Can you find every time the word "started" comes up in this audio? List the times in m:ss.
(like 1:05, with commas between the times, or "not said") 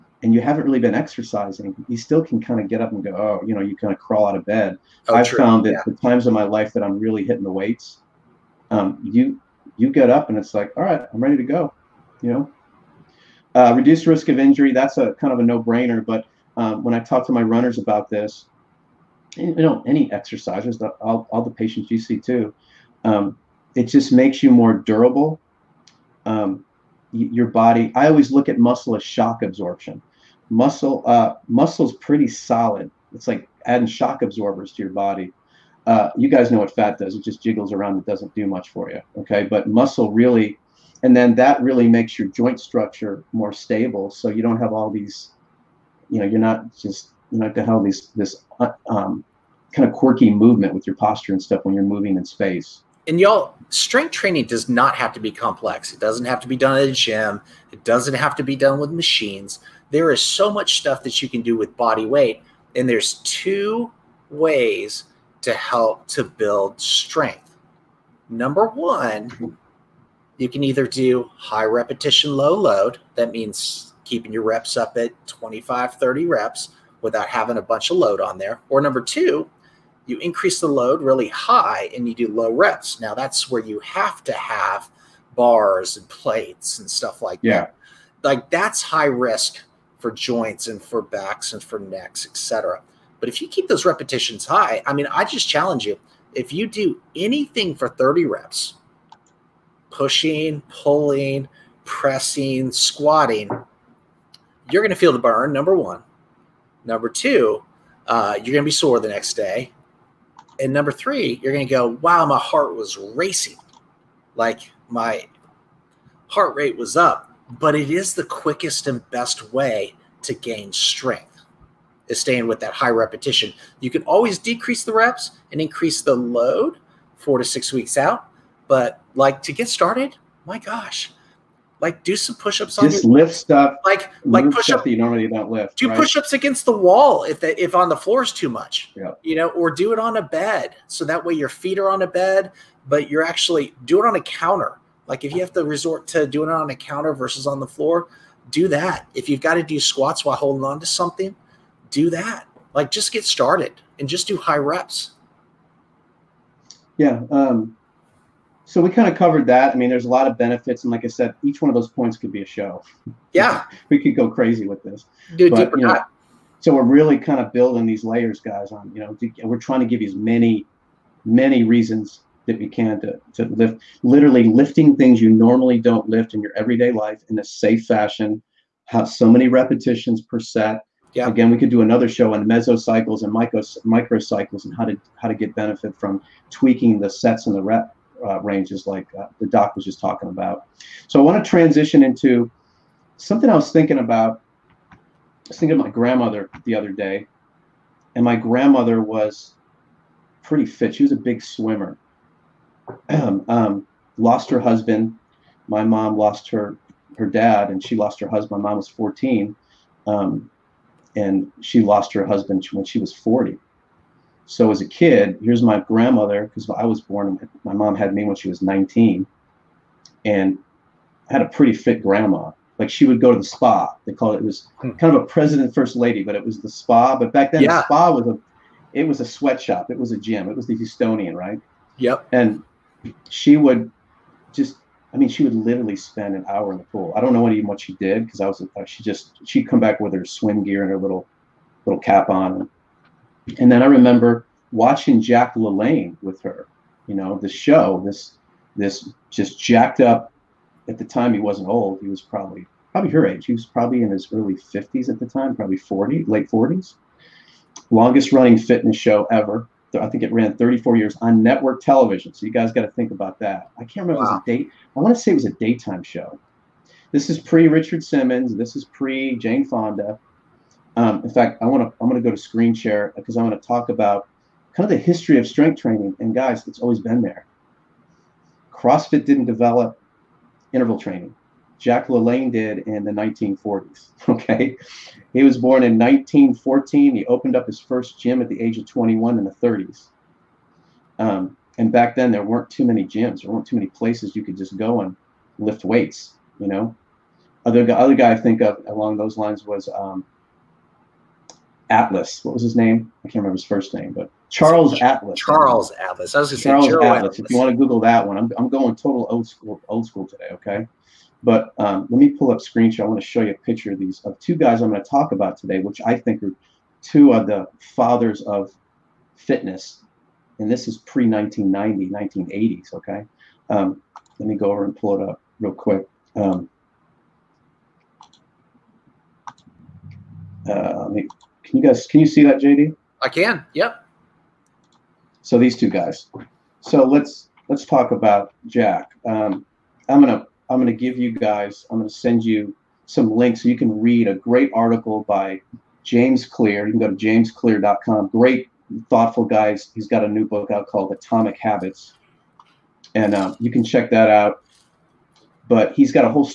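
2:09, 2:33.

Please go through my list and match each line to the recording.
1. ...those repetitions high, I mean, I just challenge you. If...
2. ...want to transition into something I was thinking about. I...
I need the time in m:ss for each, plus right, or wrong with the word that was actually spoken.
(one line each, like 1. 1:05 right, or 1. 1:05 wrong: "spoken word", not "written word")
1. 1:33 right
2. 3:11 right.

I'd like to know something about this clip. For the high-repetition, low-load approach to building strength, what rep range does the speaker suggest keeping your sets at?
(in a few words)
25 to 30.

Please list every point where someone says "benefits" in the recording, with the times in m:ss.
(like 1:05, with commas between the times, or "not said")
2:40, 3:05.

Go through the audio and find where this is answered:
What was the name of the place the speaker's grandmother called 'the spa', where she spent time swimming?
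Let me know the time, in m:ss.
3:50.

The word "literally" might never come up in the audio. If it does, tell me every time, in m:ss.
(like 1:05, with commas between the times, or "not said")
2:54, 3:55.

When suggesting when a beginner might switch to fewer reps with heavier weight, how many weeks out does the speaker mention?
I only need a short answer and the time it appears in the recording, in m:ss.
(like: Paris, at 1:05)
4 to 6 weeks, at 2:07.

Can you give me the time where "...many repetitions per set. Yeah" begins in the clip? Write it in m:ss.
2:59.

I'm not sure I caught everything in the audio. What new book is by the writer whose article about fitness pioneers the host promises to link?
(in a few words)
Atomic Habits.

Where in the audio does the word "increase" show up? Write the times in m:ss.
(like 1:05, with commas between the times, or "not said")
1:20, 2:05.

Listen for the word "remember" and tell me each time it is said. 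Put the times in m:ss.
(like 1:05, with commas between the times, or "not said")
4:03, 4:24, 5:03.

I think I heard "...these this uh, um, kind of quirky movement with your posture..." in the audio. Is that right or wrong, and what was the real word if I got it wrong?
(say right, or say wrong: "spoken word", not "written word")
right.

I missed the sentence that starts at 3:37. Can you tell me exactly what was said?
My mom had me when she was 19, and I had a pretty fit grandma.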